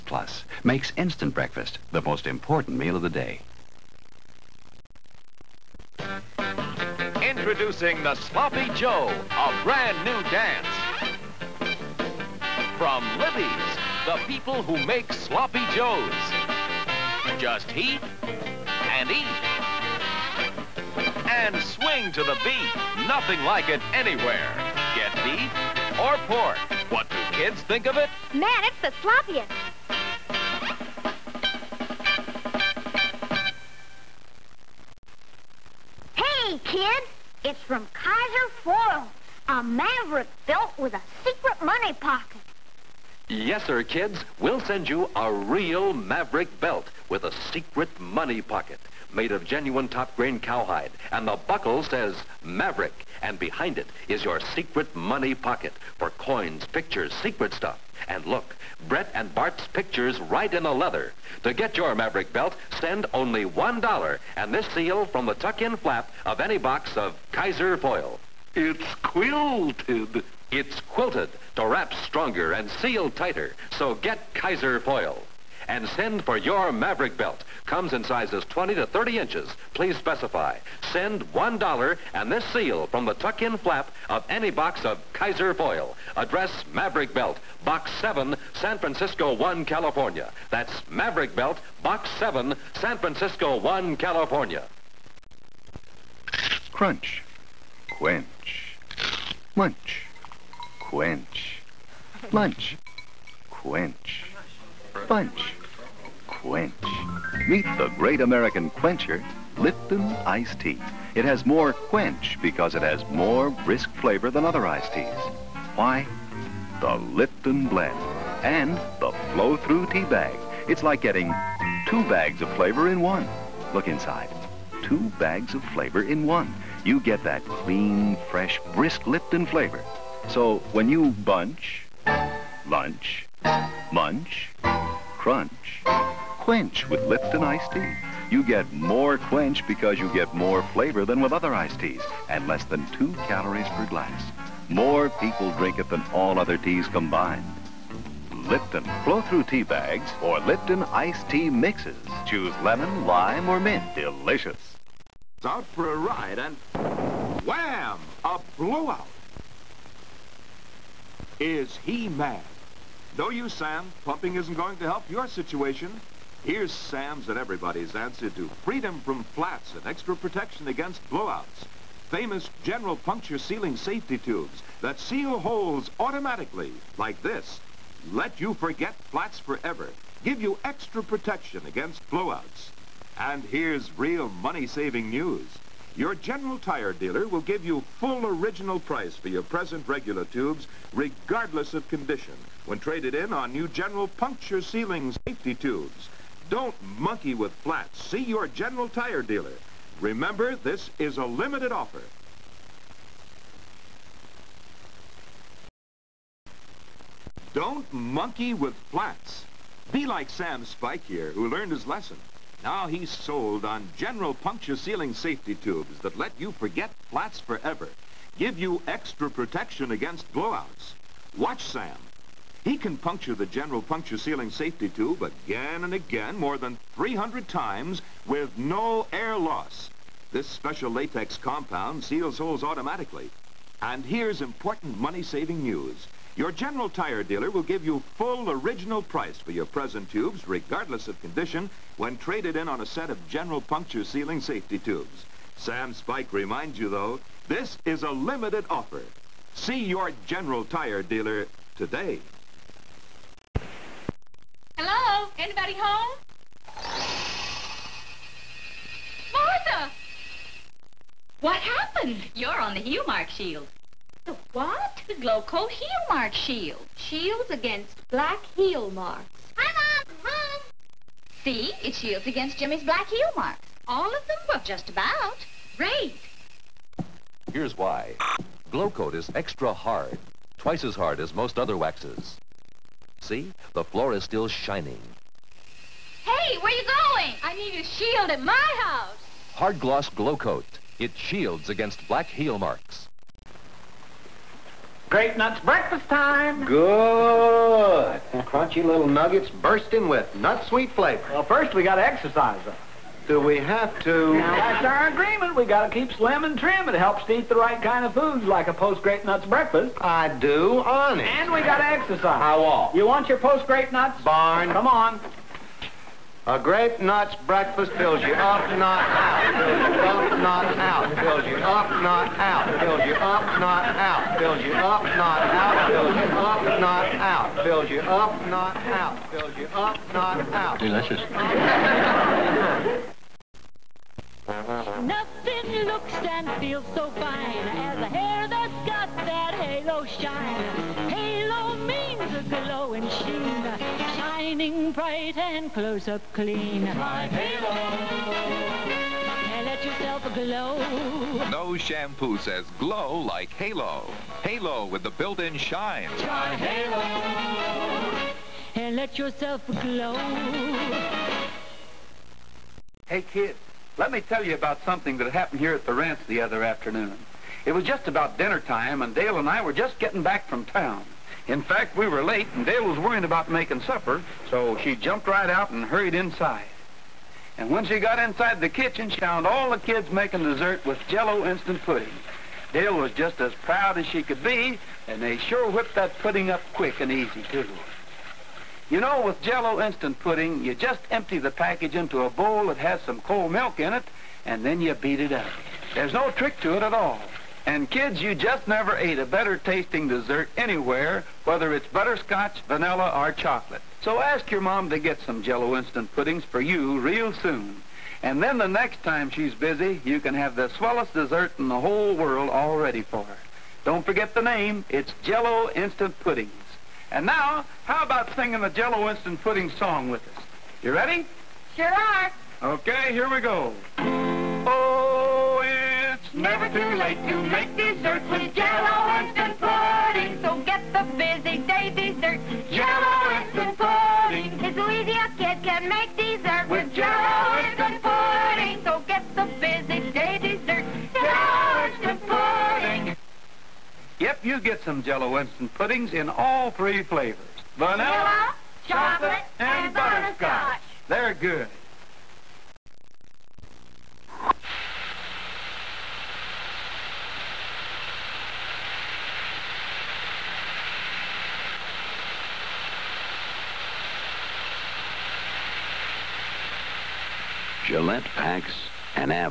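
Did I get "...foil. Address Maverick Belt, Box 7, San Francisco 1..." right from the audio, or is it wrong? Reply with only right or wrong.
right.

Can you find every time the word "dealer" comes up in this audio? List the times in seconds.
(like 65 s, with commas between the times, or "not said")
186 s, 199 s, 237 s, 251 s.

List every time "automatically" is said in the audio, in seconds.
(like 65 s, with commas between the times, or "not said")
176 s, 232 s.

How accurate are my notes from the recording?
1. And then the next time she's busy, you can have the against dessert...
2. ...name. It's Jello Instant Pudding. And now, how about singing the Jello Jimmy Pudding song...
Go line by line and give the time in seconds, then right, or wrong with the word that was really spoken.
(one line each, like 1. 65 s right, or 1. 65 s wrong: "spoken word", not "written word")
1. 408 s wrong: "swellest", not "against"
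2. 414 s wrong: "Instant", not "Jimmy".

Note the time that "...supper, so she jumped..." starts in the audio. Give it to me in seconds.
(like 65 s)
373 s.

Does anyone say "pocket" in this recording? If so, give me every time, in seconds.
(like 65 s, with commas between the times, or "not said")
41 s, 48 s, 55 s.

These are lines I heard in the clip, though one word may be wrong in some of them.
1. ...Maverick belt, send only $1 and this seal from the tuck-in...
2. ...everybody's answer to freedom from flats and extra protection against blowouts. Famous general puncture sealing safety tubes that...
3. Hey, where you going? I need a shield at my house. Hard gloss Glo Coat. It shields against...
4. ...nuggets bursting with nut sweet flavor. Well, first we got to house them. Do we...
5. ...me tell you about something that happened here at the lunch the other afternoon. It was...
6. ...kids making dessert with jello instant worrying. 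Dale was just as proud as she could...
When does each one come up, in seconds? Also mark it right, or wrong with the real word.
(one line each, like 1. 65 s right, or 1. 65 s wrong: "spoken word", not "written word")
1. 61 s right
2. 167 s right
3. 286 s right
4. 299 s wrong: "exercise", not "house"
5. 364 s wrong: "ranch", not "lunch"
6. 379 s wrong: "pudding", not "worrying".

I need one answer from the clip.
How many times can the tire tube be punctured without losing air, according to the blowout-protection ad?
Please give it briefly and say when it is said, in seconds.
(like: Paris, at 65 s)
more than 300, at 226 s.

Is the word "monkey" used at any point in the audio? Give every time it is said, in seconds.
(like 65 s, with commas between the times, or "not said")
196 s, 207 s.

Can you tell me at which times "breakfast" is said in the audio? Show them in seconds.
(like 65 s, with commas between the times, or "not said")
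1 s, 295 s, 309 s, 317 s.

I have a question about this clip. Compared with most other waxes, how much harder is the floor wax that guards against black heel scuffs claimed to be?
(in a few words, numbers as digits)
twice as hard.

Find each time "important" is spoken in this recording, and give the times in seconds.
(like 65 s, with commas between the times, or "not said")
2 s, 234 s.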